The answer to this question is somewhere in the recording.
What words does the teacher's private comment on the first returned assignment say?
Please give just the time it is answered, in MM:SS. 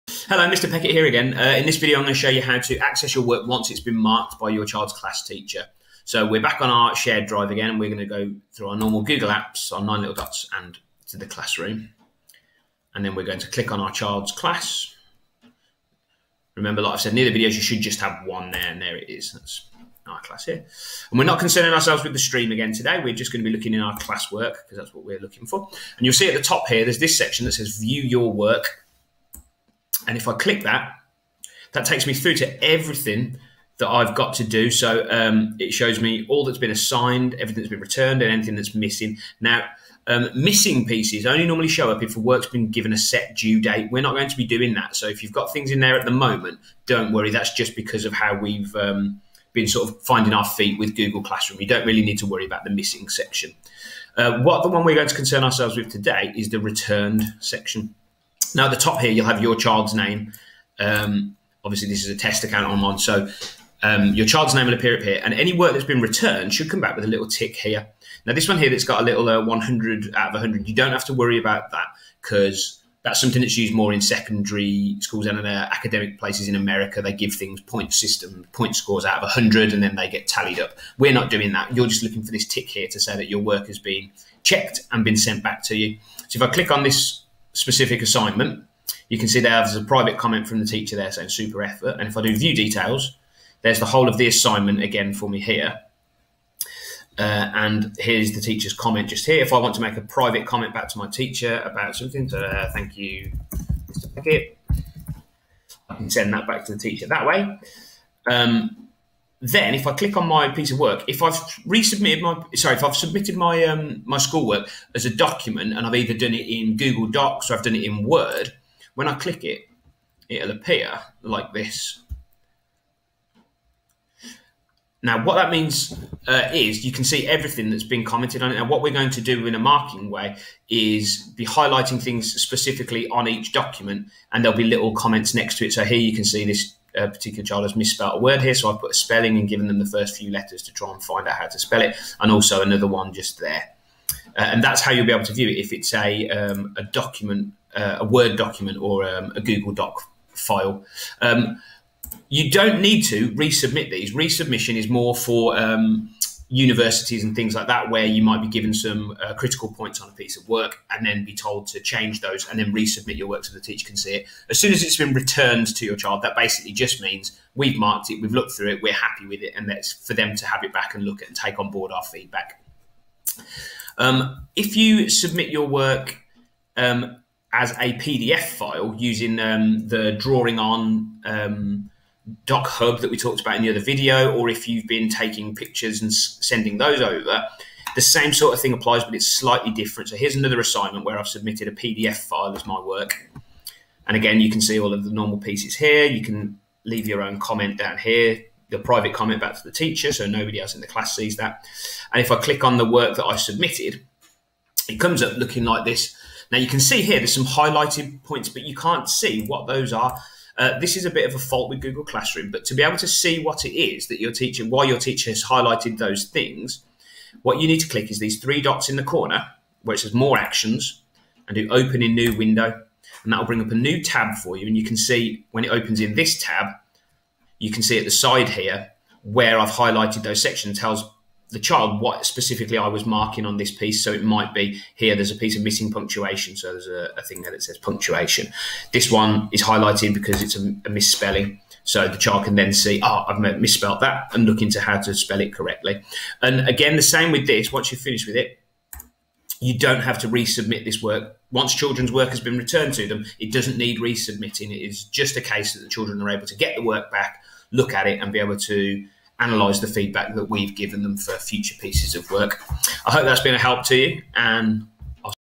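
01:31.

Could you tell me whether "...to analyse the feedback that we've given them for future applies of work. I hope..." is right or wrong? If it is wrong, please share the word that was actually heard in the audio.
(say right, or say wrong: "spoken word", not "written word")
wrong: "pieces", not "applies".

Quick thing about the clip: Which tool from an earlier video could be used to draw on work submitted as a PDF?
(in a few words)
DocHub.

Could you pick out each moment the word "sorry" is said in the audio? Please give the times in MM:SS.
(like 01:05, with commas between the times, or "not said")
01:52.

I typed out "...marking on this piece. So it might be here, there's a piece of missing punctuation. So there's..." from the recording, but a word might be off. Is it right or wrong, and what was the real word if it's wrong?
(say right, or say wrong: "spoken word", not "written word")
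right.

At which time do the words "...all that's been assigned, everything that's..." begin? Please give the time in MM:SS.
00:36.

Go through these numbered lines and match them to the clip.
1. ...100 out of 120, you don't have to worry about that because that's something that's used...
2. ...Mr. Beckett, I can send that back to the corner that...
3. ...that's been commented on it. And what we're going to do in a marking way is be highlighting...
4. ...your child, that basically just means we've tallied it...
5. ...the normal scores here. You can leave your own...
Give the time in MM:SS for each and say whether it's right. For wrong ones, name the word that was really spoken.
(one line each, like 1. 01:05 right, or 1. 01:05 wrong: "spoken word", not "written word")
1. 01:09 wrong: "100", not "120"
2. 01:43 wrong: "teacher", not "corner"
3. 02:07 right
4. 02:45 wrong: "marked", not "tallied"
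5. 03:15 wrong: "pieces", not "scores".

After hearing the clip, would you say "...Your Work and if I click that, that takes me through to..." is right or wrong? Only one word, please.
right.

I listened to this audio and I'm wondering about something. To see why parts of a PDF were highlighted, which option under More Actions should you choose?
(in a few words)
Open in New Window.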